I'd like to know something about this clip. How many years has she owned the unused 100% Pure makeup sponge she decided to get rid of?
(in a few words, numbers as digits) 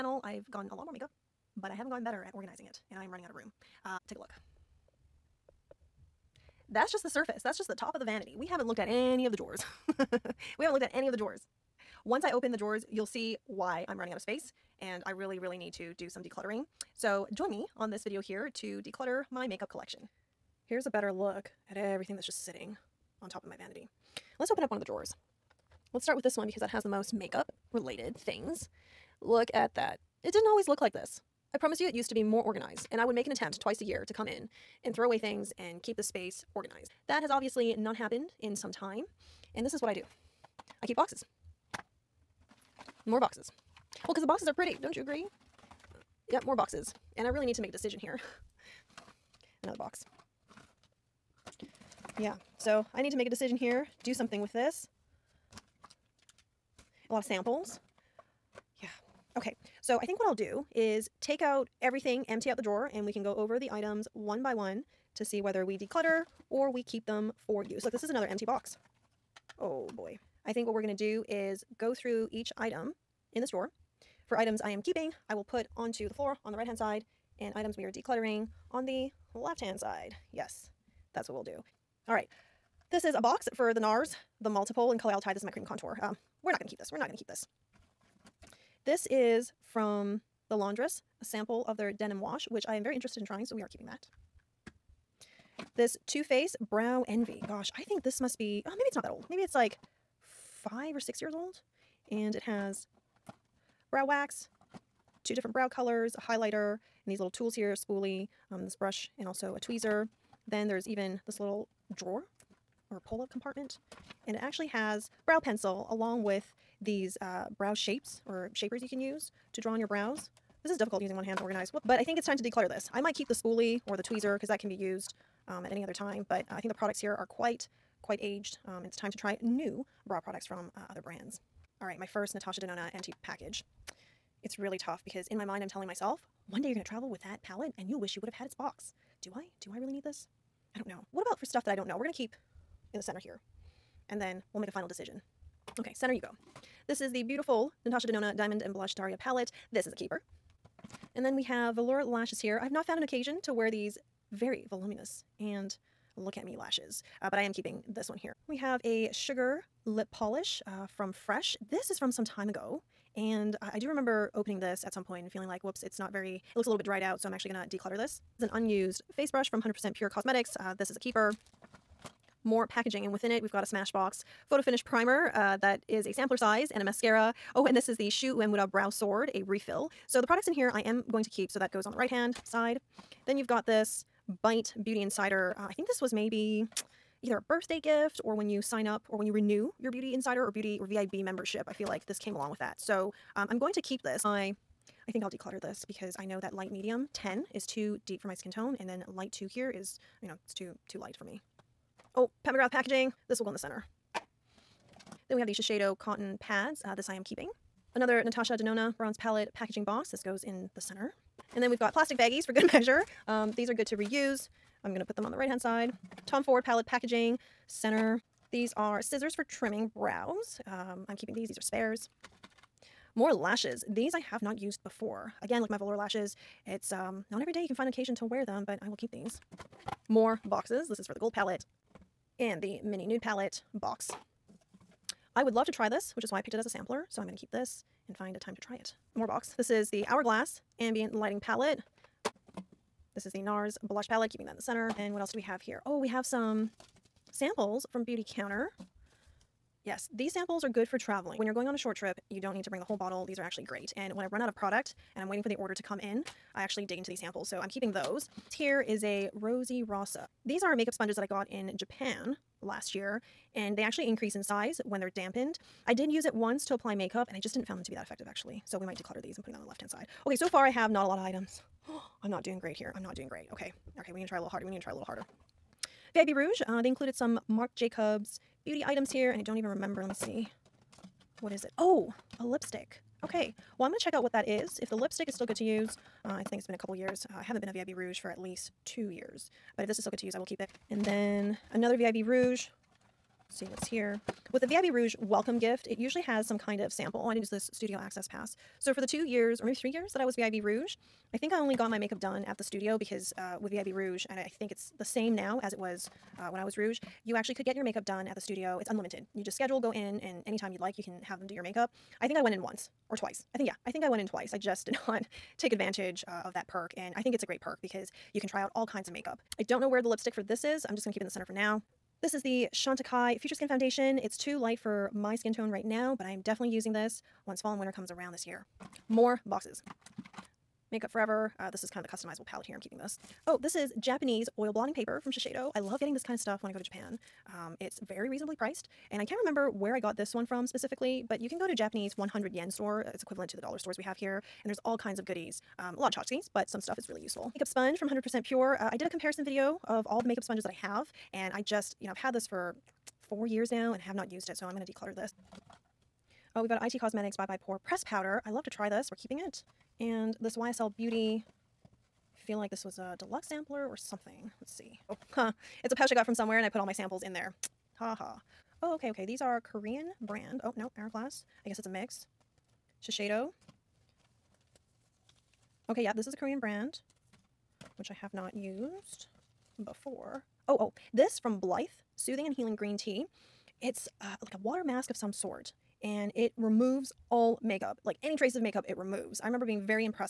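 4.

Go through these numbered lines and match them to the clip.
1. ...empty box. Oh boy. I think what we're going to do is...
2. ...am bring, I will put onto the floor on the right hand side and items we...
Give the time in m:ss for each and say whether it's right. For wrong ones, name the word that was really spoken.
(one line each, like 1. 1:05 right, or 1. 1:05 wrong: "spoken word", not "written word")
1. 1:08 right
2. 1:14 wrong: "keeping", not "bring".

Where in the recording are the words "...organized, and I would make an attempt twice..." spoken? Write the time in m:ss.
0:32.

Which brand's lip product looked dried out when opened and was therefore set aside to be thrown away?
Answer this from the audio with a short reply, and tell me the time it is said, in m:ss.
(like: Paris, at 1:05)
Fresh, at 2:41.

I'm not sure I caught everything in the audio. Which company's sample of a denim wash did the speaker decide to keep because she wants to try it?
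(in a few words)
The Laundress.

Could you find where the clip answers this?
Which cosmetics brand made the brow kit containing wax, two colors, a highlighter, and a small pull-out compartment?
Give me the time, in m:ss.
1:36.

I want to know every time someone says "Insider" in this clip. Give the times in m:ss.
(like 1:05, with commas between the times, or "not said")
3:05, 3:10.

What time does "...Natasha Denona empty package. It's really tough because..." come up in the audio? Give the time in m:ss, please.
2:12.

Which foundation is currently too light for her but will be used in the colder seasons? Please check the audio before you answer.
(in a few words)
Chantecaille Future Skin.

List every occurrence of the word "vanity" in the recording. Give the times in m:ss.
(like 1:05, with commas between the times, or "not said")
0:08, 0:23.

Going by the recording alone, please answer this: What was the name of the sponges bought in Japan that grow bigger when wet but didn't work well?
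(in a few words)
Rosy Rosa.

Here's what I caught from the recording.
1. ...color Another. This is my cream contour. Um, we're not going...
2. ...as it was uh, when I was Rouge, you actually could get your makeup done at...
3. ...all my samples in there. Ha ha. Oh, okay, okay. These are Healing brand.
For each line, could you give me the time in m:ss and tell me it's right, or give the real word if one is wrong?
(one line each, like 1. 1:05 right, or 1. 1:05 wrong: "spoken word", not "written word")
1. 1:24 wrong: "Altai", not "Another"
2. 5:05 right
3. 6:06 wrong: "Korean", not "Healing".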